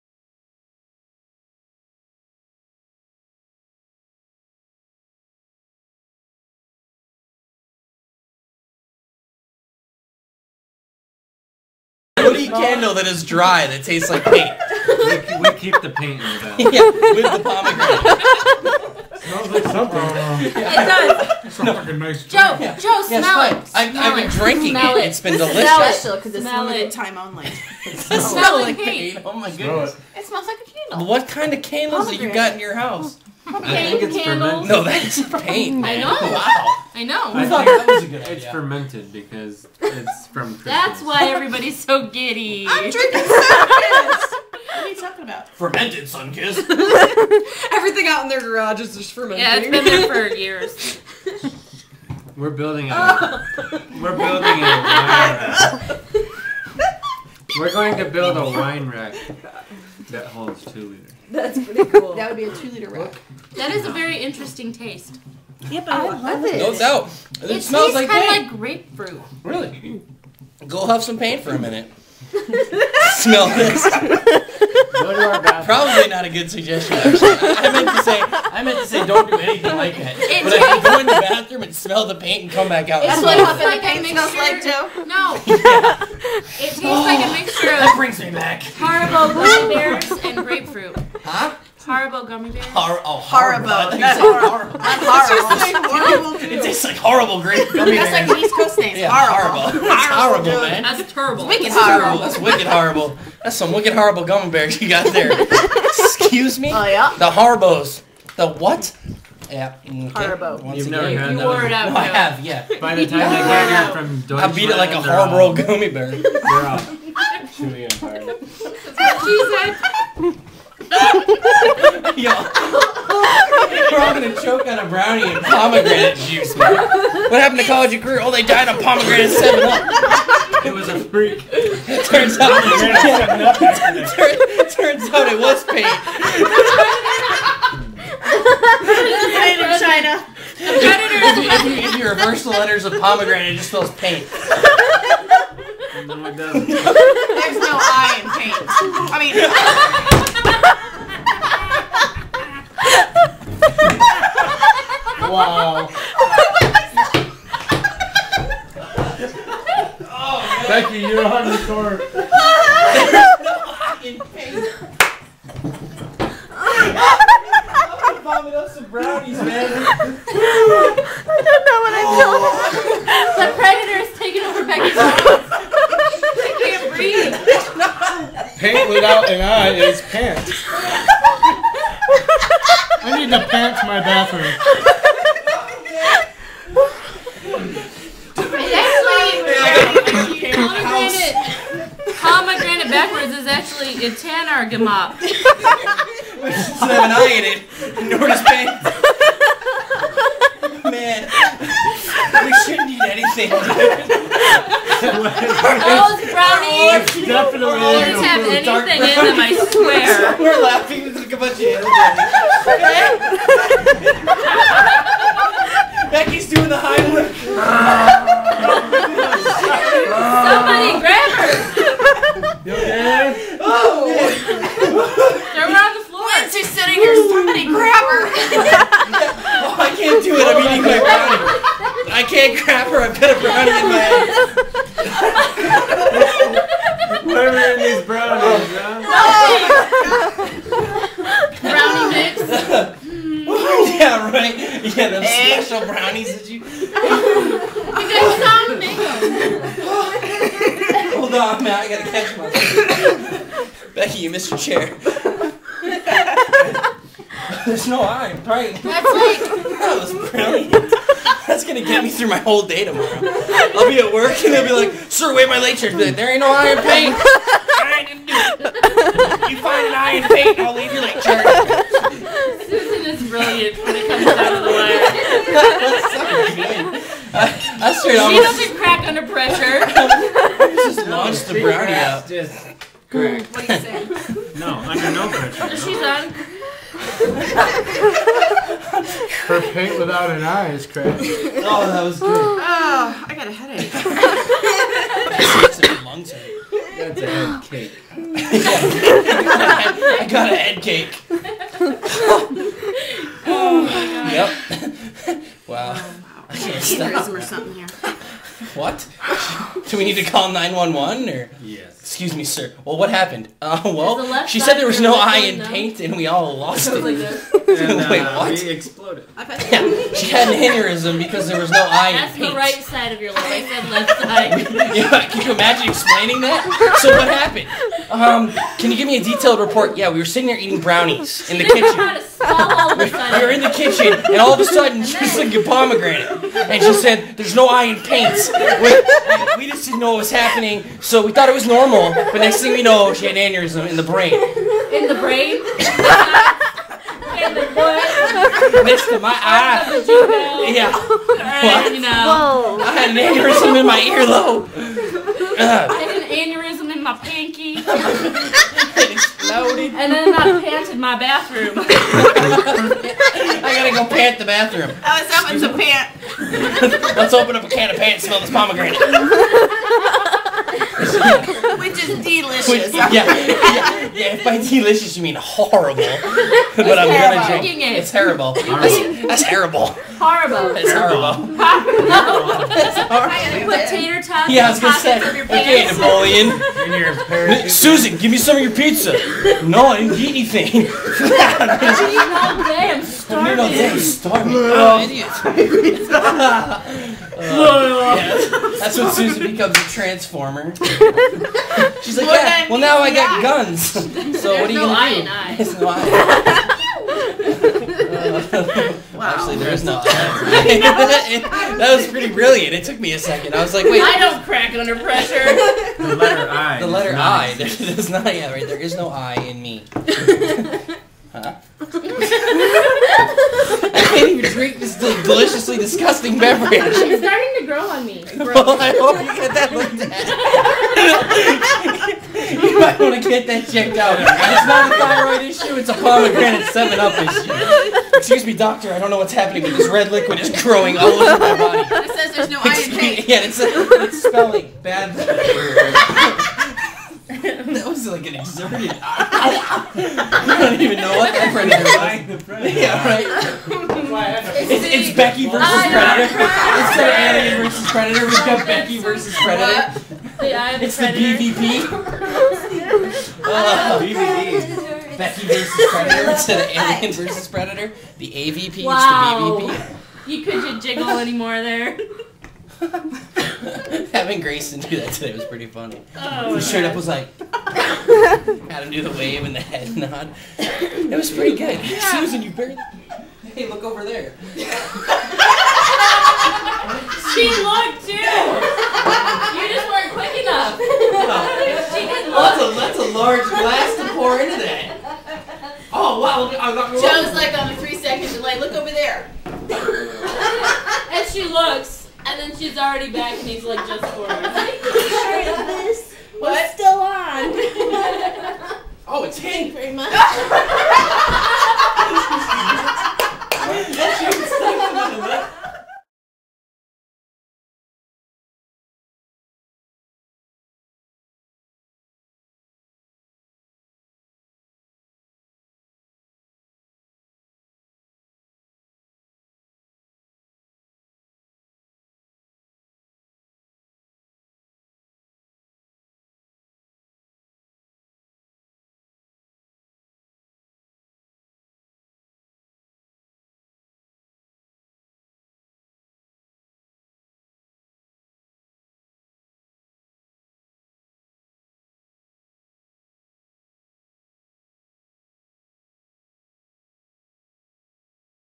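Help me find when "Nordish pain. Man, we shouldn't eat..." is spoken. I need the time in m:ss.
3:18.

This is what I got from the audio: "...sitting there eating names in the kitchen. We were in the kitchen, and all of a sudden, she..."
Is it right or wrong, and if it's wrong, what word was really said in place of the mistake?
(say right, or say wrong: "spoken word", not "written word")
wrong: "brownies", not "names".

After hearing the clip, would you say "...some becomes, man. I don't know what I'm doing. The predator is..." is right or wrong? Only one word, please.
wrong.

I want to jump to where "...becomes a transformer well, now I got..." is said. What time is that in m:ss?
6:39.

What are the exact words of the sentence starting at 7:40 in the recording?
The it's the, the BVP uh, Becky versus Predator to the Alien versus Predator.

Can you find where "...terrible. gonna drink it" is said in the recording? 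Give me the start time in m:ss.
6:17.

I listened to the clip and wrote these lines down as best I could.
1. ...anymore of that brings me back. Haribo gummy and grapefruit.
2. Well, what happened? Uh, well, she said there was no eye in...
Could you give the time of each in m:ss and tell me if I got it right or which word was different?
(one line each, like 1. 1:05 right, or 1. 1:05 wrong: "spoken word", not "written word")
1. 1:27 wrong: "mixture", not "anymore"
2. 5:12 right.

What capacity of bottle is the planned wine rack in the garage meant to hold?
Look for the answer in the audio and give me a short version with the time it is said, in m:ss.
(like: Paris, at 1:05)
2 liters, at 1:00.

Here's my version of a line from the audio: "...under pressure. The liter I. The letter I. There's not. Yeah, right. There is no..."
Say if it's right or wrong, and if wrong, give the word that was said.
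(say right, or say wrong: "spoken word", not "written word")
wrong: "letter", not "liter".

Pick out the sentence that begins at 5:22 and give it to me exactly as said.
the right side of your life.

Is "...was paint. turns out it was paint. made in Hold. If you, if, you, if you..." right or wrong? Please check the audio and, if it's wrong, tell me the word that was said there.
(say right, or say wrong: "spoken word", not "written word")
wrong: "China", not "Hold".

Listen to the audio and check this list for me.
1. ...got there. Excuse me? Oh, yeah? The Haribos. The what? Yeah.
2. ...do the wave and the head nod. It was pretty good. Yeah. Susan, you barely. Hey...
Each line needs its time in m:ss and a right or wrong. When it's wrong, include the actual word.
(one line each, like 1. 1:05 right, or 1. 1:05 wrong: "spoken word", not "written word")
1. 1:44 right
2. 7:58 right.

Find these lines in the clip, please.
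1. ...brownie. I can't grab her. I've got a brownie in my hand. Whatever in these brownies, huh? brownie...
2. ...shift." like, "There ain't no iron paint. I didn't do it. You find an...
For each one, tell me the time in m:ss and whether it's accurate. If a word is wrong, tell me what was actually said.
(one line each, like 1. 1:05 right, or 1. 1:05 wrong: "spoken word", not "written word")
1. 3:50 right
2. 4:25 right.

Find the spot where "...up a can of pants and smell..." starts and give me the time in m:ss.
6:07.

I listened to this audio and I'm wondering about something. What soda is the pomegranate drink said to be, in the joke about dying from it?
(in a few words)
Seven Up.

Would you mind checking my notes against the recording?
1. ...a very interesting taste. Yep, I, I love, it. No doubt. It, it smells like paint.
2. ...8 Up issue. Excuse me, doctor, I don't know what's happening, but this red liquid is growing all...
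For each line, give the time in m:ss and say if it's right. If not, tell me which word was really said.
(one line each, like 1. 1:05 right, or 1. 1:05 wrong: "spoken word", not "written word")
1. 1:03 right
2. 7:16 wrong: "7", not "8".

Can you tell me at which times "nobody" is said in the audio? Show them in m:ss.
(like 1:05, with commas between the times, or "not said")
not said.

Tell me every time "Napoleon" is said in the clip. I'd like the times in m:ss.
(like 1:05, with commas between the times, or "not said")
6:25.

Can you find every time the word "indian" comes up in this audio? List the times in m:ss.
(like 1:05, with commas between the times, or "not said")
not said.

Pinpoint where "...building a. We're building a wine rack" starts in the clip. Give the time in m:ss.
0:52.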